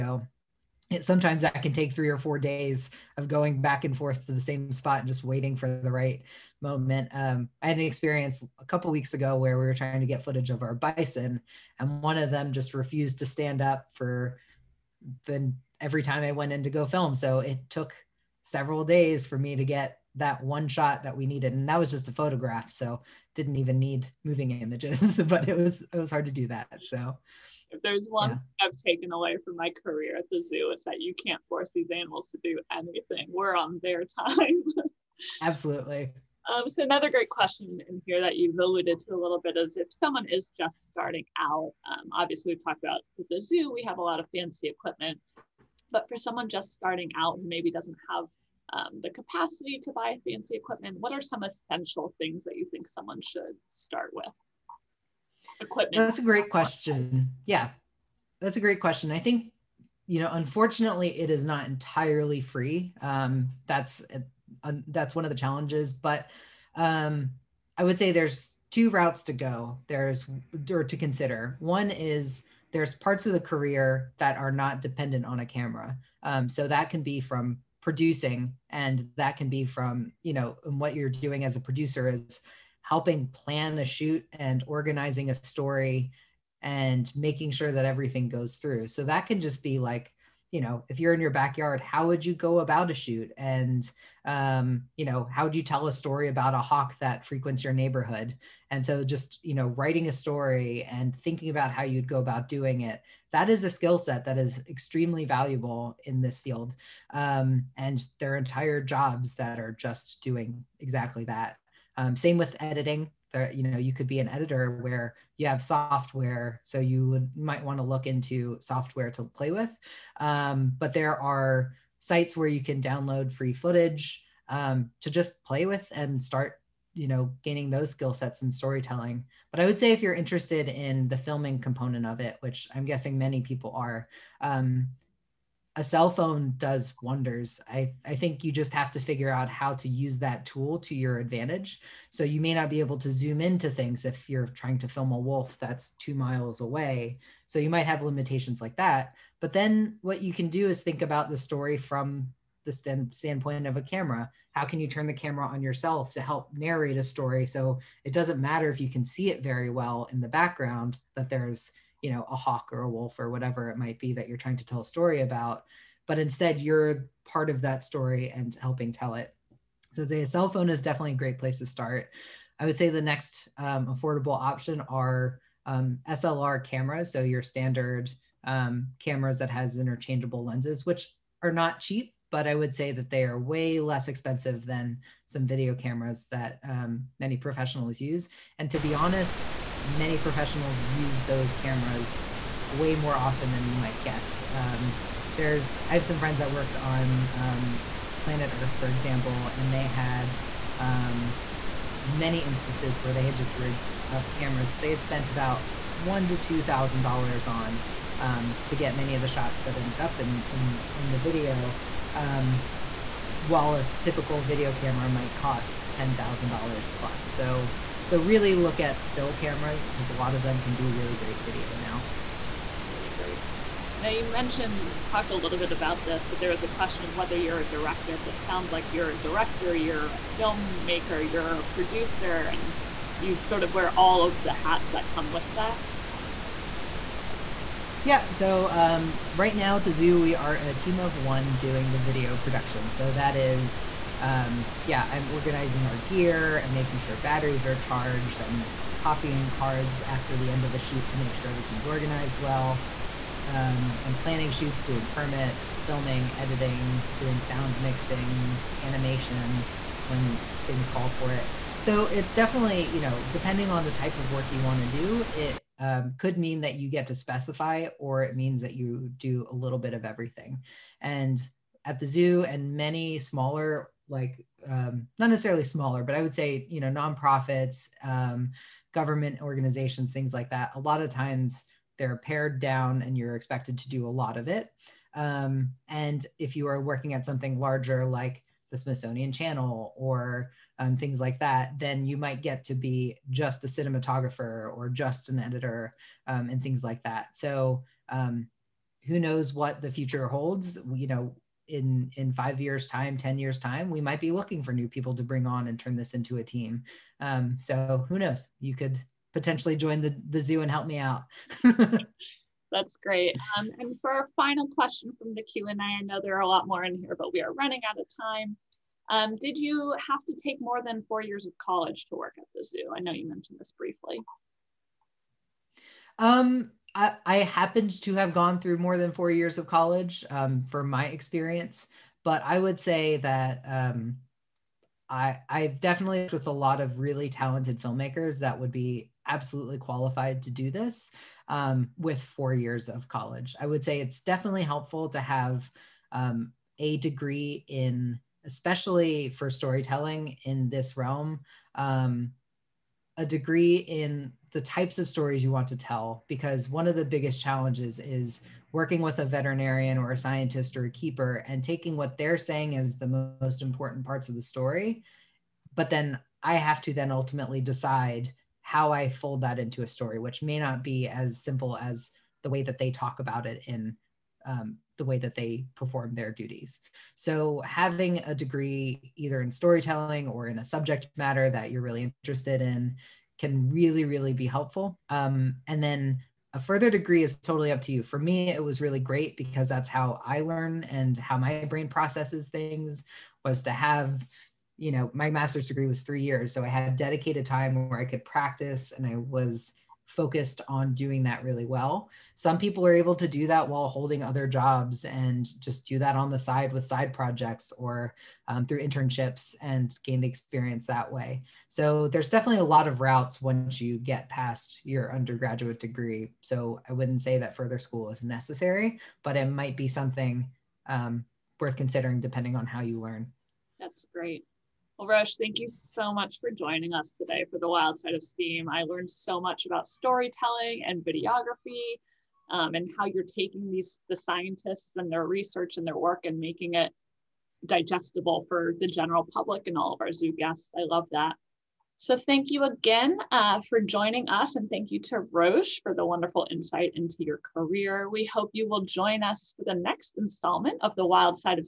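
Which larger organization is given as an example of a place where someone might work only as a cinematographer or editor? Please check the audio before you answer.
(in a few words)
Smithsonian Channel.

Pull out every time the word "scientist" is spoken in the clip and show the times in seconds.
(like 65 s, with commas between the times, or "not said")
360 s, 434 s.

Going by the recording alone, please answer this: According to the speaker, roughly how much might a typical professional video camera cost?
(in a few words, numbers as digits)
$10,000 plus.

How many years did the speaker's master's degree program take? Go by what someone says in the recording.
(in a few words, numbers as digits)
3 years.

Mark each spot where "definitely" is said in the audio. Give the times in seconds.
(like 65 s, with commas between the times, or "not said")
170 s, 262 s, 335 s, 344 s, 412 s.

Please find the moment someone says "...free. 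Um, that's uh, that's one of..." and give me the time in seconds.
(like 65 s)
62 s.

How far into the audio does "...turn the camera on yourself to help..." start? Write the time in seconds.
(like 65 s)
154 s.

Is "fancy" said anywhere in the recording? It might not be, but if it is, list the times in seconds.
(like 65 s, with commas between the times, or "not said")
44 s, 50 s.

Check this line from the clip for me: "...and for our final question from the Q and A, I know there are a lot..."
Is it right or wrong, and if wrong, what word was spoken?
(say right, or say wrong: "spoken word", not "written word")
right.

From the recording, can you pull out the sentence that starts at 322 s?
I know you mentioned this briefly.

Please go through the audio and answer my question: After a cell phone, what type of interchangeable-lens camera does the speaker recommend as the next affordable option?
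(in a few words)
SLR cameras.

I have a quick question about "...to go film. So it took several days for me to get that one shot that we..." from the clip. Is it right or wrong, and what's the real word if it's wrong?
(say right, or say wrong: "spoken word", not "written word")
right.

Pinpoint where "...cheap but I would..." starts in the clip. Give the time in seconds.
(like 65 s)
181 s.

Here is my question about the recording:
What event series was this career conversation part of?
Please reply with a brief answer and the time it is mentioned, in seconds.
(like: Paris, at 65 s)
Wild Side of STEAM, at 427 s.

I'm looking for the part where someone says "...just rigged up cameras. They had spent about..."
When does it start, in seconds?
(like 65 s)
203 s.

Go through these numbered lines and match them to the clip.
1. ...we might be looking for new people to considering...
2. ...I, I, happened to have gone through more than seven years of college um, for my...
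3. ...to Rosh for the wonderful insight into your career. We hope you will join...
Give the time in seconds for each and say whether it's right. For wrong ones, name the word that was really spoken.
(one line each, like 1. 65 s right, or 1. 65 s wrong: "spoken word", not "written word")
1. 303 s wrong: "bring", not "considering"
2. 326 s wrong: "four", not "seven"
3. 445 s right.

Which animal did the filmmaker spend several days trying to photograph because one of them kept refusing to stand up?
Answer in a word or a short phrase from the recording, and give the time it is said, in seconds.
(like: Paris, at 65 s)
bison, at 10 s.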